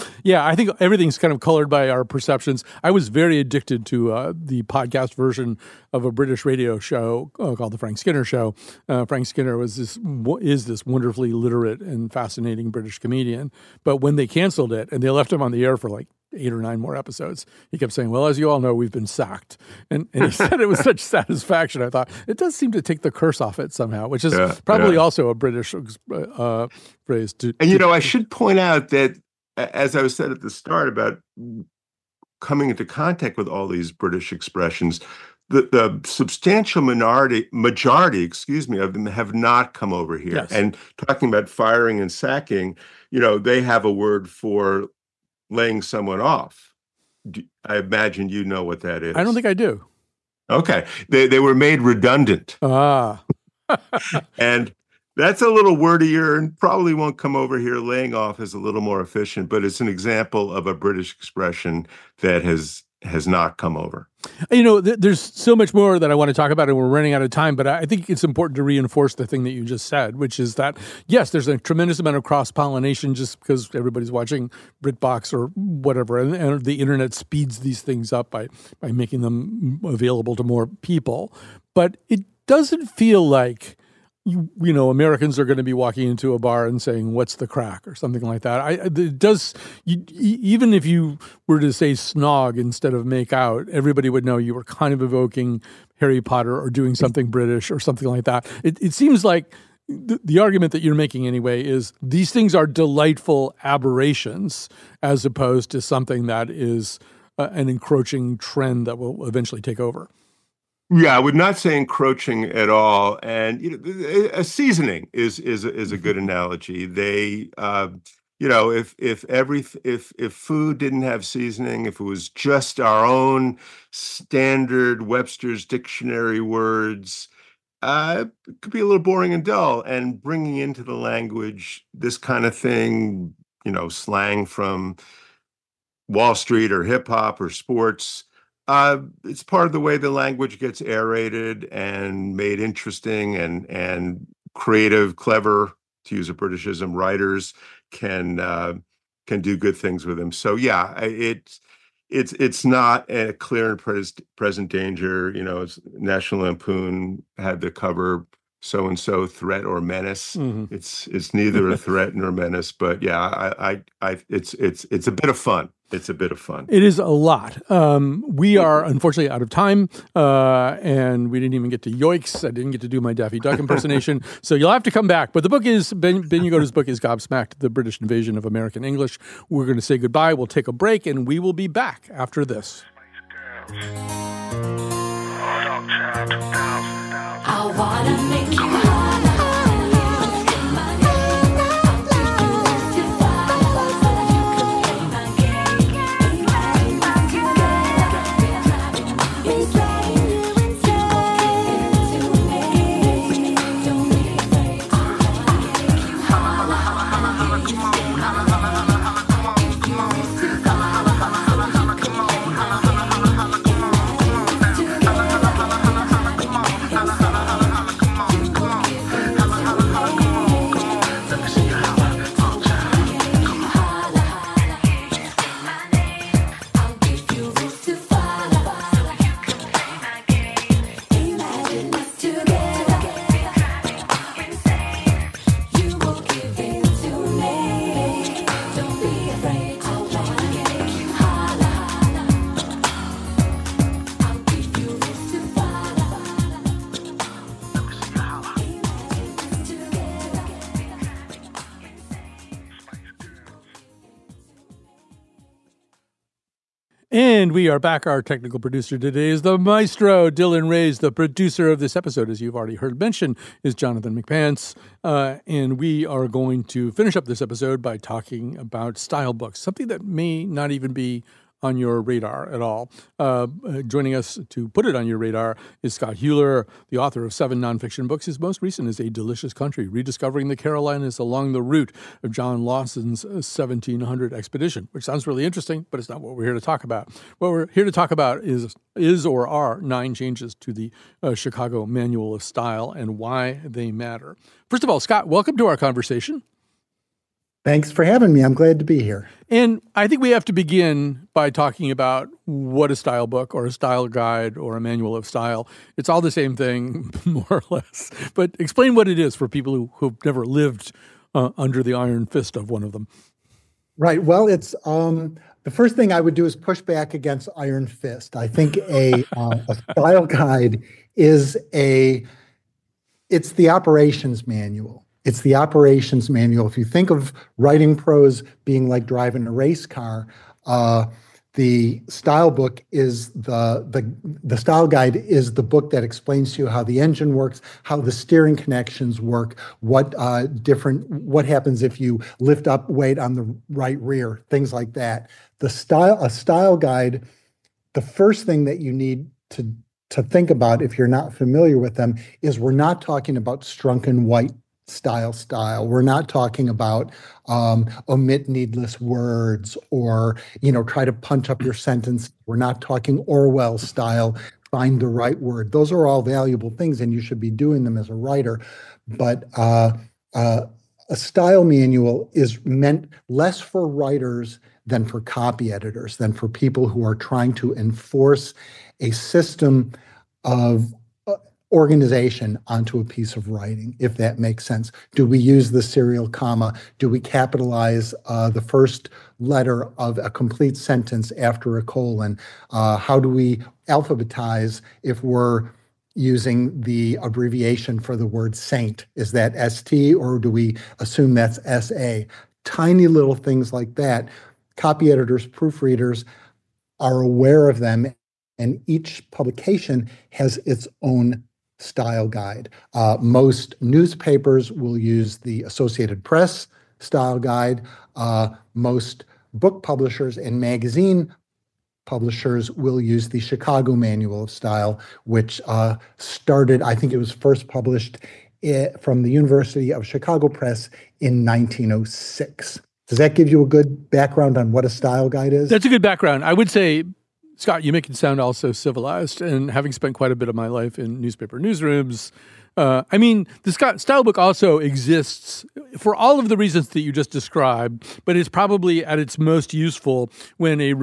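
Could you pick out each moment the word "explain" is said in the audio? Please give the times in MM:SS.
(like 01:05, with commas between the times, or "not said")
05:08, 05:36.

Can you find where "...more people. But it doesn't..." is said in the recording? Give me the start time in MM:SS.
01:20.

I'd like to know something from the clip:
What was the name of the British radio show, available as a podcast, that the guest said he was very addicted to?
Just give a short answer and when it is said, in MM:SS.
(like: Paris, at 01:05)
The Frank Skinner Show, at 00:07.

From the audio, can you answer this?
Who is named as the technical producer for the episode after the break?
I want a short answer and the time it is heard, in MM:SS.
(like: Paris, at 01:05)
Dylan Reyes, at 04:20.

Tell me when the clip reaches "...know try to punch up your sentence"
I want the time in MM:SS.
06:00.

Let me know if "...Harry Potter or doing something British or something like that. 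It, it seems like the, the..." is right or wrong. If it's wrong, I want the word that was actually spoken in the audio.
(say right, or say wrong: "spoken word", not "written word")
right.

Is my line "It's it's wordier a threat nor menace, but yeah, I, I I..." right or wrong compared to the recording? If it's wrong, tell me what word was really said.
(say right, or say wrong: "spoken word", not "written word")
wrong: "neither", not "wordier".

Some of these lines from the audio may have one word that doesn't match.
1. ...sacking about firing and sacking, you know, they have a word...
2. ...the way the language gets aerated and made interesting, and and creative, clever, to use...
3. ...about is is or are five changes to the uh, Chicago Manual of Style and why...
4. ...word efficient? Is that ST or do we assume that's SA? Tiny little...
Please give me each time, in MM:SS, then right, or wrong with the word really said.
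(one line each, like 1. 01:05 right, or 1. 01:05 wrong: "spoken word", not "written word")
1. 00:41 wrong: "talking", not "sacking"
2. 02:19 right
3. 04:48 wrong: "nine", not "five"
4. 06:38 wrong: "saint", not "efficient".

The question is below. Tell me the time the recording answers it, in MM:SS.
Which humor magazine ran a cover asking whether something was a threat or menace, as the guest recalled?
02:35.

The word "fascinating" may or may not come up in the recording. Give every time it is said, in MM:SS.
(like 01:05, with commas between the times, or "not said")
00:12.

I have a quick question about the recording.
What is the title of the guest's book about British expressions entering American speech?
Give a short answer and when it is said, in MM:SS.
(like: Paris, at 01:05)
Gobsmacked, at 02:56.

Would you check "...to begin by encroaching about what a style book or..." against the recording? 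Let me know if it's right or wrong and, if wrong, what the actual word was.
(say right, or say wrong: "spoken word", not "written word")
wrong: "talking", not "encroaching".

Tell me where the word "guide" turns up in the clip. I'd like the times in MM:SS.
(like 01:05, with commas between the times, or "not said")
05:04, 05:20, 05:34, 05:46, 06:52, 06:57, 07:15.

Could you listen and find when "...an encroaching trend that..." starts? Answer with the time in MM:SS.
01:47.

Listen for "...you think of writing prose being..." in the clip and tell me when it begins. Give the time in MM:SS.
05:26.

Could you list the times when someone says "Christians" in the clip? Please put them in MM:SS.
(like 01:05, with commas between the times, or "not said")
not said.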